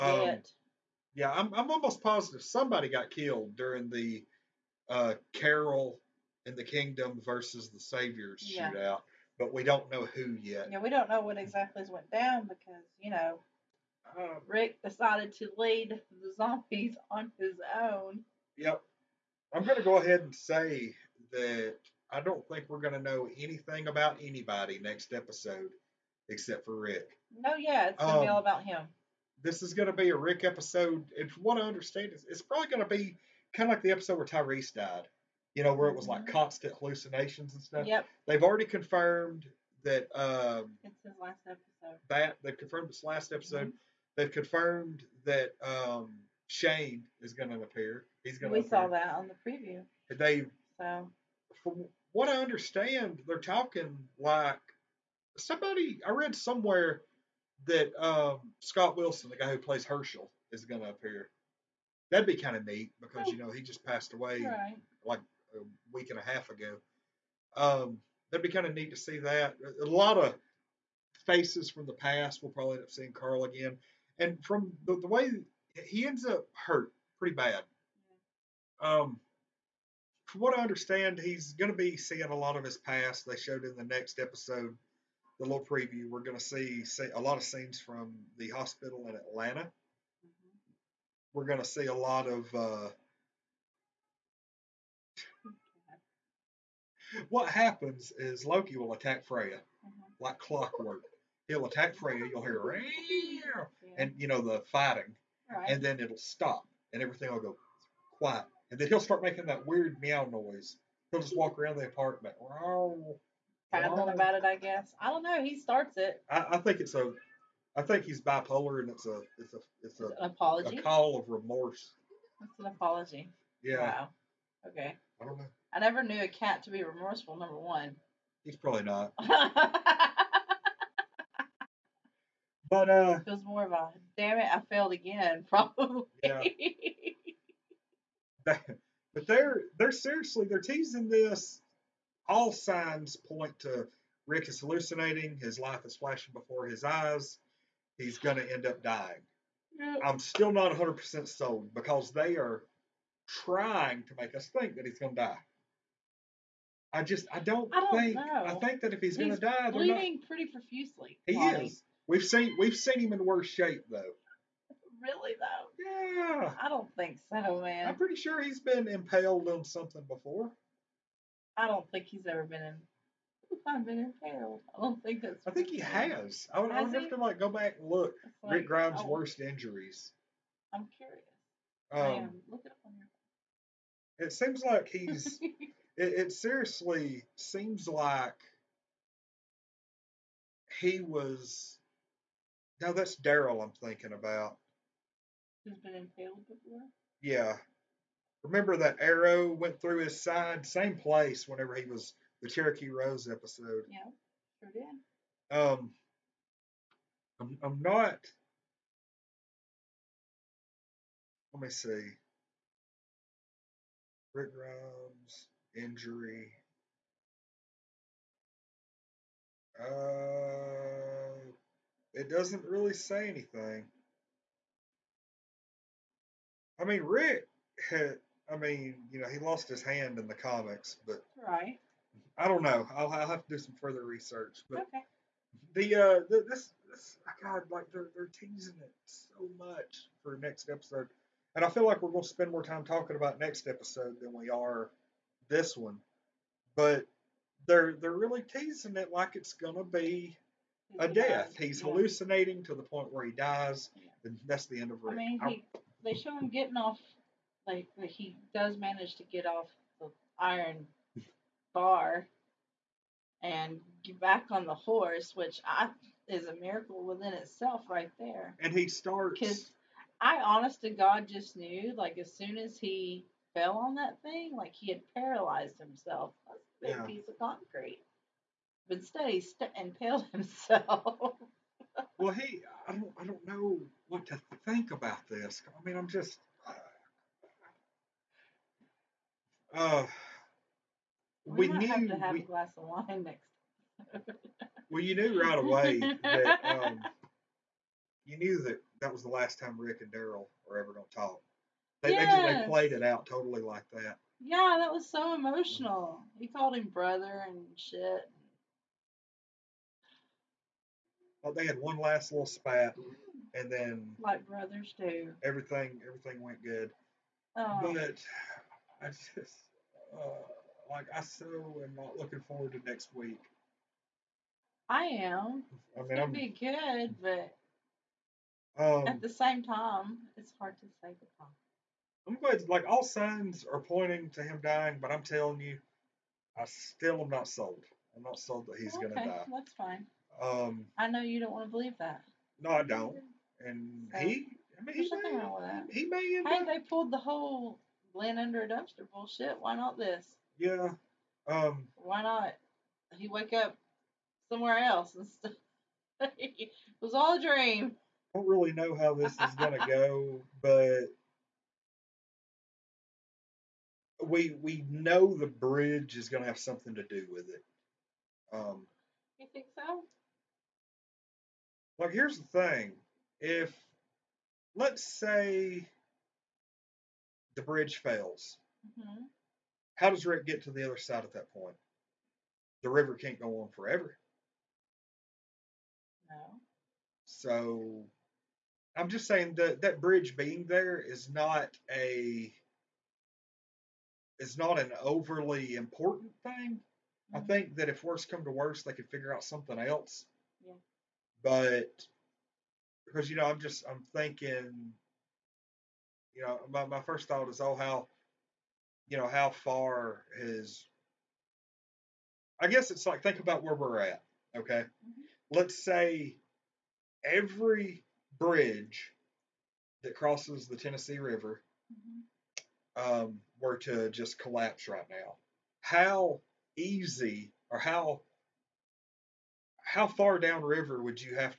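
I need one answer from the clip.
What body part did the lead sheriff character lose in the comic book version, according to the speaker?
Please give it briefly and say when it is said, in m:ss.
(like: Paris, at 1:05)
his hand, at 3:49.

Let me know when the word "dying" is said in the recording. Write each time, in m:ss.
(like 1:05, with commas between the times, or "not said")
2:28, 5:34.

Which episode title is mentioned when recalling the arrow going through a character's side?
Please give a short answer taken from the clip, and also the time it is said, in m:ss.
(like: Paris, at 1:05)
Cherokee Rose, at 3:22.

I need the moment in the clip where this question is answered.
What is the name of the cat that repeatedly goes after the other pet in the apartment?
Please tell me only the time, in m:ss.
1:38.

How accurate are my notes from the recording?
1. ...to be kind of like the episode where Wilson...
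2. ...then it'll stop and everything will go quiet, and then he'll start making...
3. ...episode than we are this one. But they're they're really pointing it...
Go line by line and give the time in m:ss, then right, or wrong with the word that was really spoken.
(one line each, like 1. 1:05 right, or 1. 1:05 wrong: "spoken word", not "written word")
1. 0:32 wrong: "Tyrese", not "Wilson"
2. 1:45 right
3. 4:03 wrong: "teasing", not "pointing".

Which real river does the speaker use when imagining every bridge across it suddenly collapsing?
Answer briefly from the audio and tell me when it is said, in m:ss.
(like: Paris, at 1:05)
Tennessee River, at 7:00.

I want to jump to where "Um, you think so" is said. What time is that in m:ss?
6:08.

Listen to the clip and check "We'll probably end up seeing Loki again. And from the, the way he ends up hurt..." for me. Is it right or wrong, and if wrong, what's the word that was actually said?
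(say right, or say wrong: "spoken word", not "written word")
wrong: "Carl", not "Loki".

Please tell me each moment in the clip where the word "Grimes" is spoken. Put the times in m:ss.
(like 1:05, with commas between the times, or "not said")
2:58, 3:34.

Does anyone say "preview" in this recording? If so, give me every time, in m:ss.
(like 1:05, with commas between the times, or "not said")
0:49, 1:25.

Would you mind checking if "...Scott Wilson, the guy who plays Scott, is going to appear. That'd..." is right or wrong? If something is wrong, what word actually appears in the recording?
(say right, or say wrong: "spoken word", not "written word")
wrong: "Hershel", not "Scott".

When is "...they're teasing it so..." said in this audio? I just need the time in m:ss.
3:58.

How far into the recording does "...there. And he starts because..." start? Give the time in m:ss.
4:28.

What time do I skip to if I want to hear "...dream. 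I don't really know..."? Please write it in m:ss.
5:57.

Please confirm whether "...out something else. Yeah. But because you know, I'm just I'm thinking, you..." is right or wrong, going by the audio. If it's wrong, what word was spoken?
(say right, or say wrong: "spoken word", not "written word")
right.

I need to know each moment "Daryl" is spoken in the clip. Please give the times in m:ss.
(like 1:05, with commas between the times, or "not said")
3:13, 5:00.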